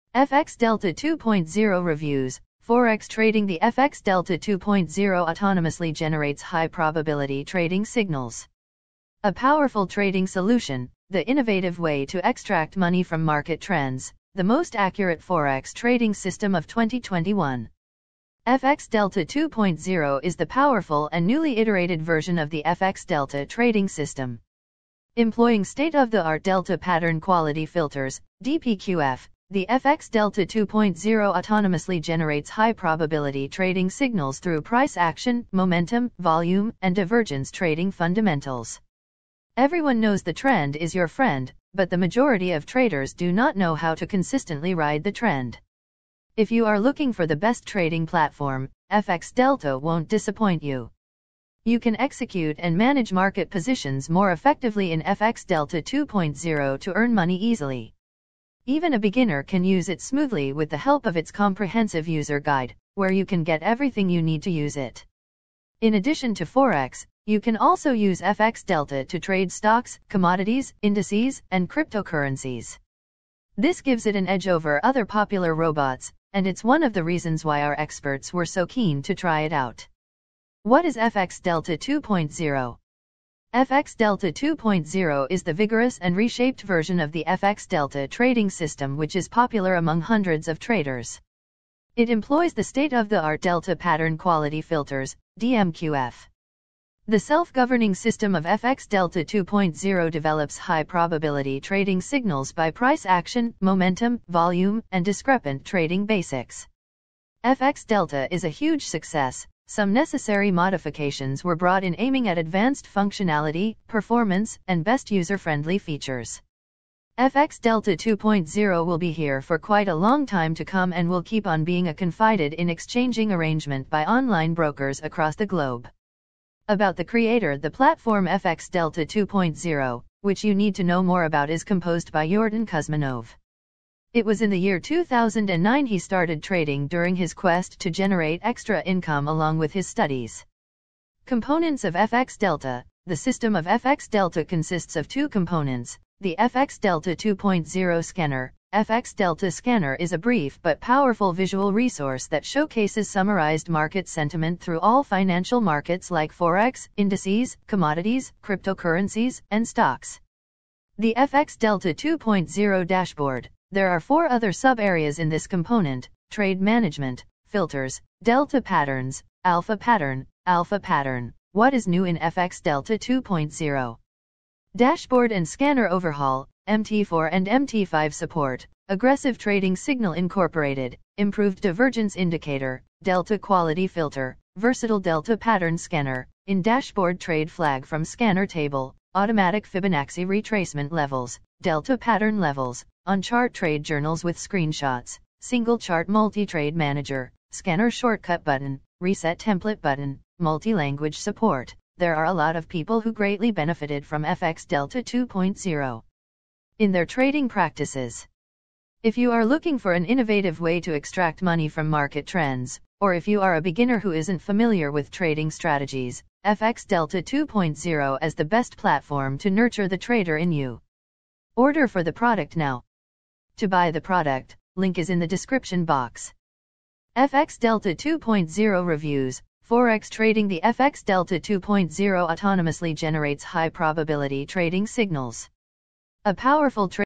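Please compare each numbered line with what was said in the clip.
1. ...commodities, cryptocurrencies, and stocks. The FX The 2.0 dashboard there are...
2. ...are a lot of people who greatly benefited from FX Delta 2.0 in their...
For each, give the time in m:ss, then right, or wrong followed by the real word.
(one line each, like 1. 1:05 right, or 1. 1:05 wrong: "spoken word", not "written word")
1. 2:37 wrong: "Delta", not "The"
2. 3:22 right.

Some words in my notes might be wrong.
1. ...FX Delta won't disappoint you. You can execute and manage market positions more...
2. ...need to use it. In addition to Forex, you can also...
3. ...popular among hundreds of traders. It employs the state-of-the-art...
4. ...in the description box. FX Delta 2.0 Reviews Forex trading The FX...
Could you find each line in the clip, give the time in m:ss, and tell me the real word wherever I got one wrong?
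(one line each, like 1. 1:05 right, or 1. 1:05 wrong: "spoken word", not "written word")
1. 0:48 right
2. 1:04 right
3. 1:29 right
4. 3:45 right.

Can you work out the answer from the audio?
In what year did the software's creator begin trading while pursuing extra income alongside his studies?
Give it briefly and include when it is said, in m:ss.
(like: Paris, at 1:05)
2009, at 2:14.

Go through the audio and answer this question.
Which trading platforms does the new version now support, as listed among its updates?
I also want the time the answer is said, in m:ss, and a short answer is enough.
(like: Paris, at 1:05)
MT4 and MT5, at 2:56.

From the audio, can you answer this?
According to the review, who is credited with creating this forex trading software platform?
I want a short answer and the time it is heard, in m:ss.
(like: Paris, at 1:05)
Jordan Kuzminov, at 2:12.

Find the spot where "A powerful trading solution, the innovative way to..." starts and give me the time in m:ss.
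0:09.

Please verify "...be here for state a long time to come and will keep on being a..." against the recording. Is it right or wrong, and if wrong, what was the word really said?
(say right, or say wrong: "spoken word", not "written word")
wrong: "quite", not "state".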